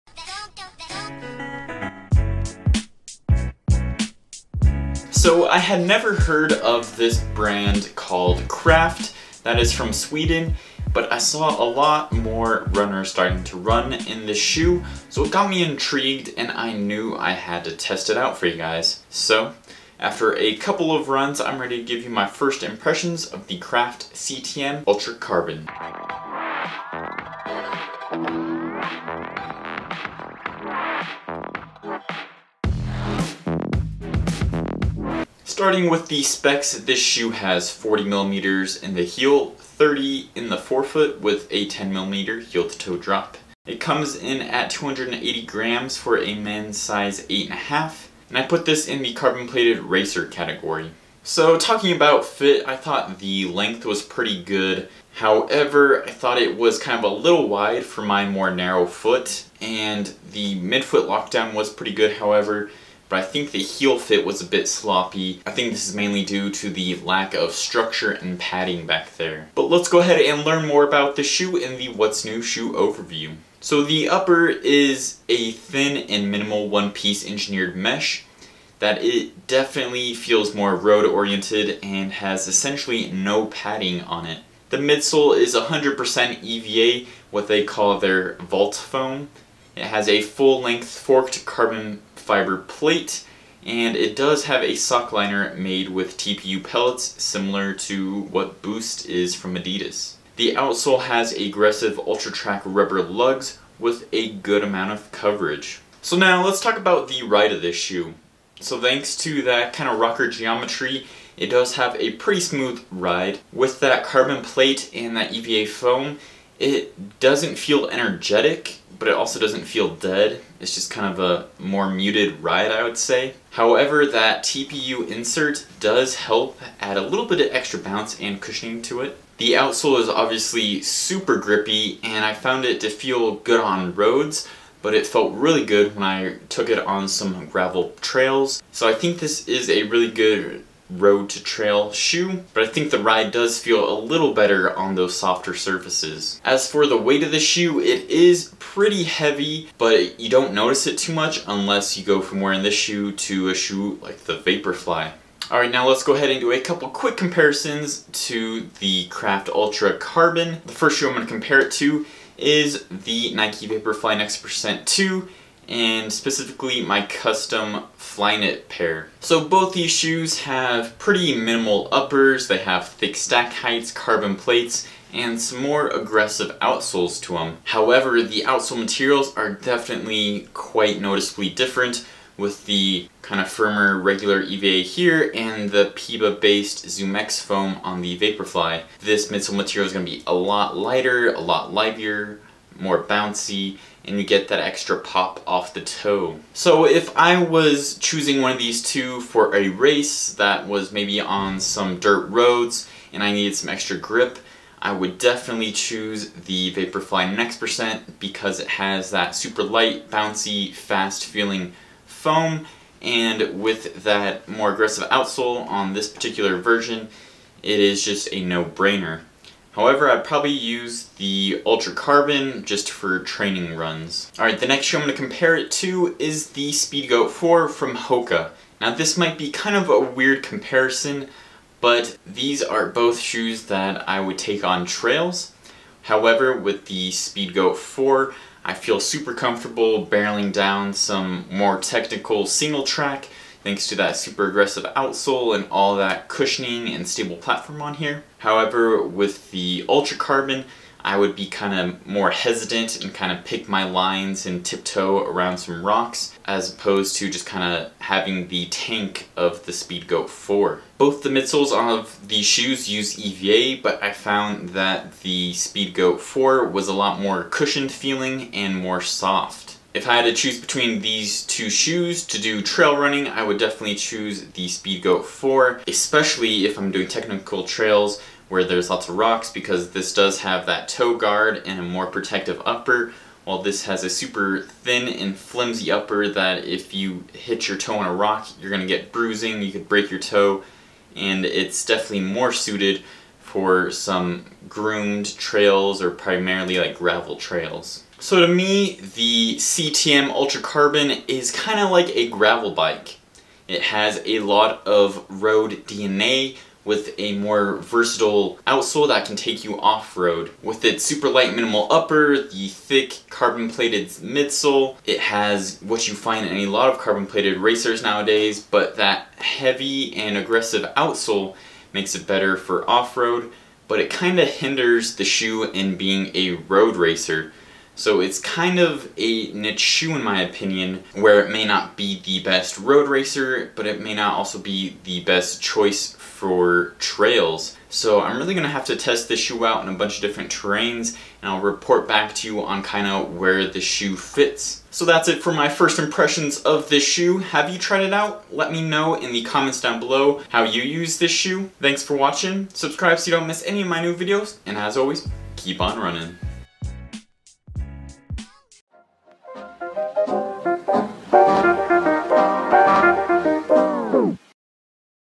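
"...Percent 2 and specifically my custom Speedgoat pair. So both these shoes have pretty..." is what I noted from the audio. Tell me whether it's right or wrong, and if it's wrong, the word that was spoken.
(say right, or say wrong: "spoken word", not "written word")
wrong: "Flyknit", not "Speedgoat".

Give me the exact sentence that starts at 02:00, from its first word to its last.
It's just kind of a more muted ride, I would say.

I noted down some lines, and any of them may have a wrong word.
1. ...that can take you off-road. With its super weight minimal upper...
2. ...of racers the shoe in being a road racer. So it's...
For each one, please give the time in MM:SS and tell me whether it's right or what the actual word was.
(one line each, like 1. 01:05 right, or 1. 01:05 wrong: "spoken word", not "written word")
1. 05:09 wrong: "light", not "weight"
2. 05:24 wrong: "hinders", not "racers".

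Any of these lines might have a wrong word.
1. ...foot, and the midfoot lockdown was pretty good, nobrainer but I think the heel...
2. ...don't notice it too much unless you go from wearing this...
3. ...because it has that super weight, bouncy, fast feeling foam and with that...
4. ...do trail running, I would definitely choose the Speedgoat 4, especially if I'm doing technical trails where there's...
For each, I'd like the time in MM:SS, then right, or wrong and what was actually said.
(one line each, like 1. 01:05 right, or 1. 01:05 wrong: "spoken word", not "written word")
1. 00:58 wrong: "however", not "nobrainer"
2. 02:30 right
3. 03:28 wrong: "light", not "weight"
4. 04:32 right.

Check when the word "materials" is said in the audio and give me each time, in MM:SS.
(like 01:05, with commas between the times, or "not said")
02:58, 03:09.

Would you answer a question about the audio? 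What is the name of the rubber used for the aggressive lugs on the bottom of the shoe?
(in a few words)
Ultratrack.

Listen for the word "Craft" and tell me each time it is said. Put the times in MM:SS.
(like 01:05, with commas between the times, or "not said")
00:08, 00:23, 02:39.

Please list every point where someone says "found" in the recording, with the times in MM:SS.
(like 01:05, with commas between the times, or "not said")
02:12, 04:24.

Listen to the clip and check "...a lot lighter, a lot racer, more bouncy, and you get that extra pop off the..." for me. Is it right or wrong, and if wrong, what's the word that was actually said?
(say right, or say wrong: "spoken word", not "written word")
wrong: "livier", not "racer".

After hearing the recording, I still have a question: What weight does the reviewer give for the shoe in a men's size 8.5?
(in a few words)
280 grams.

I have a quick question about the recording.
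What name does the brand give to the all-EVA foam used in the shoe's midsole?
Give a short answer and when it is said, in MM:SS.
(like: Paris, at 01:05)
Vault, at 01:28.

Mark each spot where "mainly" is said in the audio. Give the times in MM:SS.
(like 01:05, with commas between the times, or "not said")
01:05.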